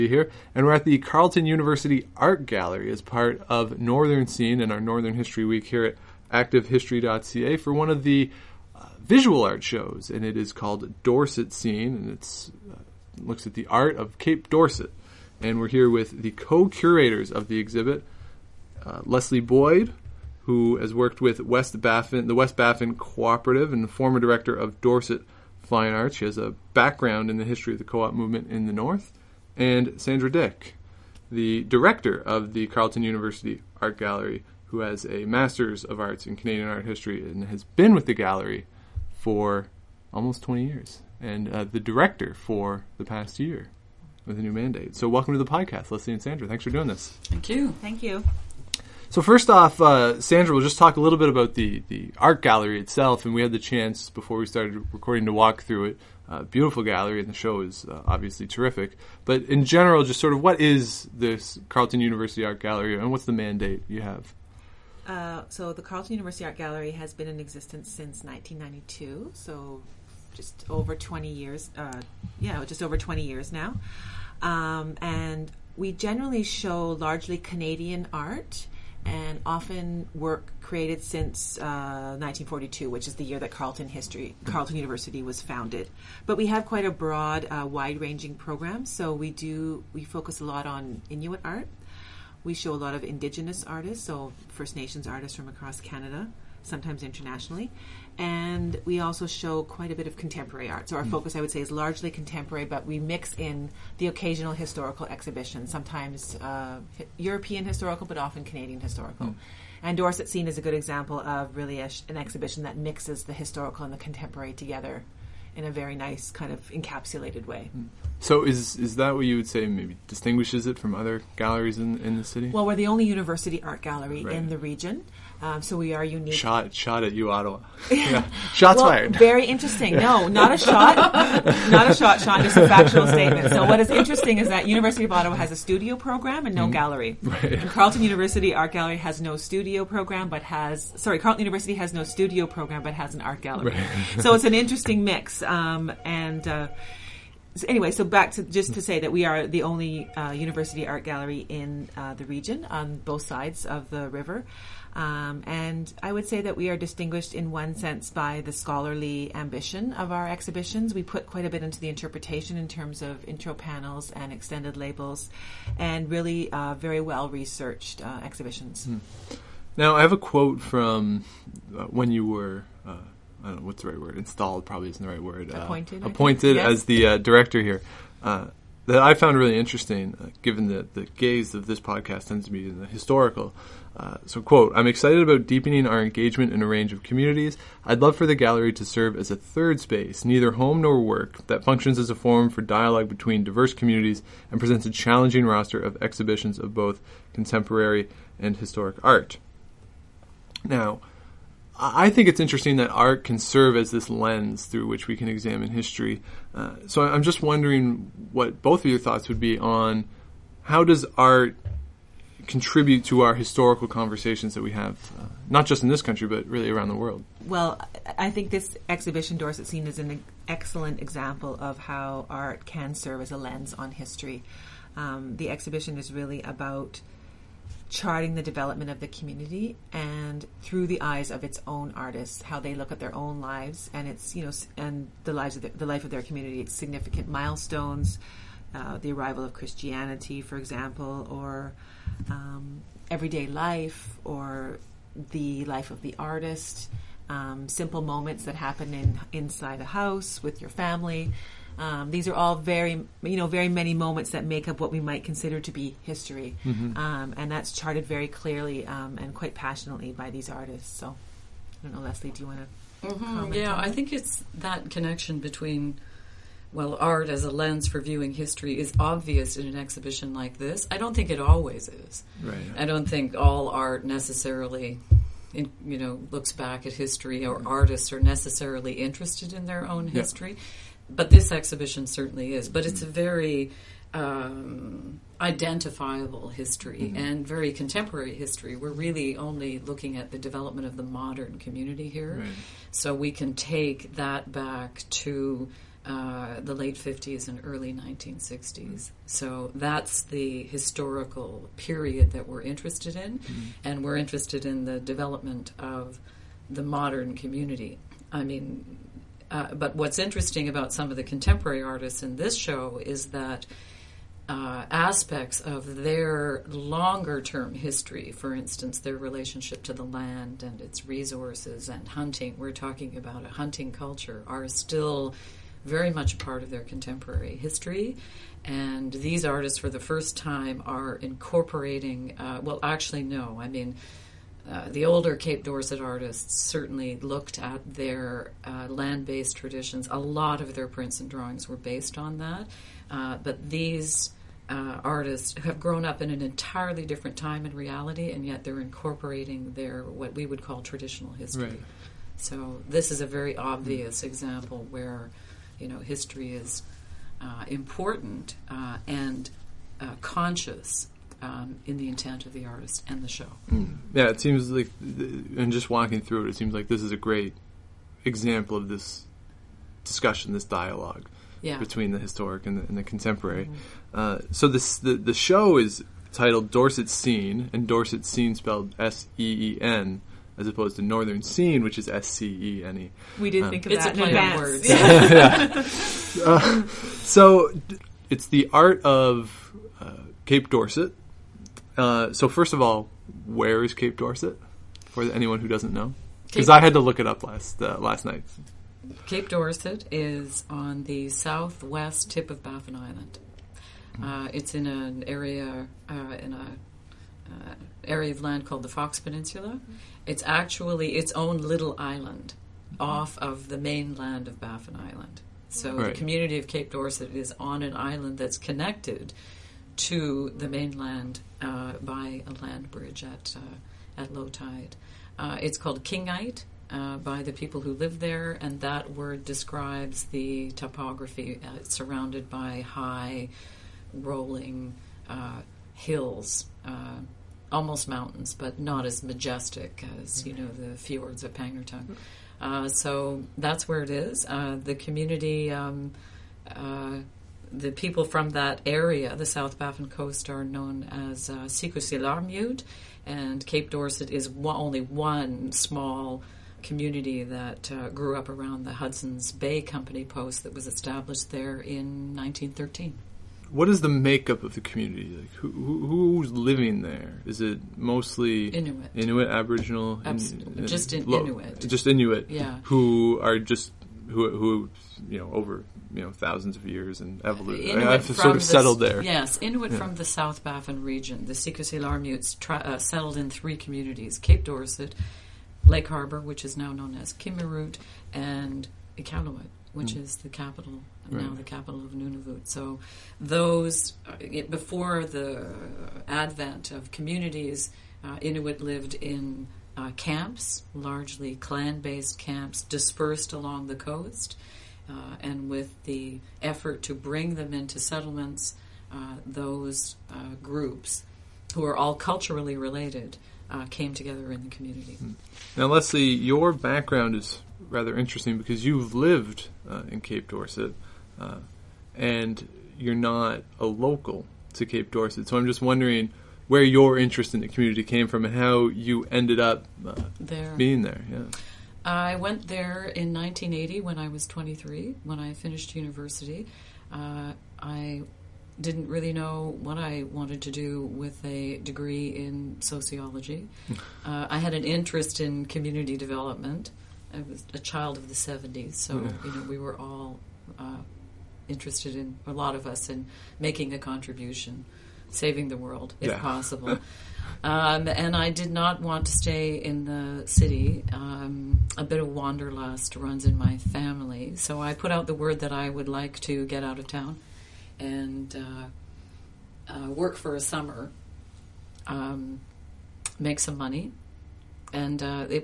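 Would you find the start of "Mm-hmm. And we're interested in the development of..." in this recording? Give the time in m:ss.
5:03.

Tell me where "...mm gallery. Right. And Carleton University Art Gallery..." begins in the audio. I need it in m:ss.
2:16.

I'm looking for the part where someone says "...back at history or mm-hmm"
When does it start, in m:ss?
4:36.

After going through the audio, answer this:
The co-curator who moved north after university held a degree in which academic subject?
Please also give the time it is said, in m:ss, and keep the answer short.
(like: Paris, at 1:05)
Sociology, at 9:02.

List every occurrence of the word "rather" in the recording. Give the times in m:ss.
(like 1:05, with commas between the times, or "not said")
8:37.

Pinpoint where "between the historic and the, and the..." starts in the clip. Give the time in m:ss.
6:11.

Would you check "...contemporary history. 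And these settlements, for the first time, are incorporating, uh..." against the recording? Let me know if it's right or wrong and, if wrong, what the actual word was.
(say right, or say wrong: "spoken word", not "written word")
wrong: "artists", not "settlements".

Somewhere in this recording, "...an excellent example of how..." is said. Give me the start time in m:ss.
3:39.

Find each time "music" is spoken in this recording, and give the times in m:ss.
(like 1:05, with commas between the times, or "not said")
not said.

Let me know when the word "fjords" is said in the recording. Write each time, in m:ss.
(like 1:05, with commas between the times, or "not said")
7:20.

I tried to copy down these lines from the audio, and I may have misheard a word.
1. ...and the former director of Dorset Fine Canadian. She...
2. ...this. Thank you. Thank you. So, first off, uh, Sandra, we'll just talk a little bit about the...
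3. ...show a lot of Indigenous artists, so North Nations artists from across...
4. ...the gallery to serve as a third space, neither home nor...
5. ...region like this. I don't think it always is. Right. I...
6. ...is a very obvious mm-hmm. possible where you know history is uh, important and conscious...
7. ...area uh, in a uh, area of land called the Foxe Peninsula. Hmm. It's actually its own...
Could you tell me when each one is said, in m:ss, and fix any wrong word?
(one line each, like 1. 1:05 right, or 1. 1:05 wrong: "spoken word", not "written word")
1. 0:23 wrong: "Arts", not "Canadian"
2. 0:46 right
3. 1:32 wrong: "First", not "North"
4. 3:08 right
5. 4:29 wrong: "exhibition", not "region"
6. 5:53 wrong: "example", not "possible"
7. 6:45 right.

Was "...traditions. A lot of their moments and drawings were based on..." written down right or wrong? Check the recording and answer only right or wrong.
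wrong.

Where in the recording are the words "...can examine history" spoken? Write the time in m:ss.
3:25.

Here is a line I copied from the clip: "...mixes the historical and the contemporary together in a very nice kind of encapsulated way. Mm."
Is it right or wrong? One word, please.
right.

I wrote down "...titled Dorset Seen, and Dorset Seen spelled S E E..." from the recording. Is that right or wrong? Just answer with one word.
right.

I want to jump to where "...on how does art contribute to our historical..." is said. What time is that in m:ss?
3:29.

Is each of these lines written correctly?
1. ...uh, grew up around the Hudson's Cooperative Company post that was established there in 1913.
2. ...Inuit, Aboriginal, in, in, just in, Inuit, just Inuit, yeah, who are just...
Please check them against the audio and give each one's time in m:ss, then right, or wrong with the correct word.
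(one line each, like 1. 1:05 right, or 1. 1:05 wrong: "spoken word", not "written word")
1. 7:37 wrong: "Bay", not "Cooperative"
2. 7:49 right.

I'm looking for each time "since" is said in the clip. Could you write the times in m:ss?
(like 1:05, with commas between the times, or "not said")
1:07, 1:21.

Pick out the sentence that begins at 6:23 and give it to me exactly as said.
We did um, think of it's that.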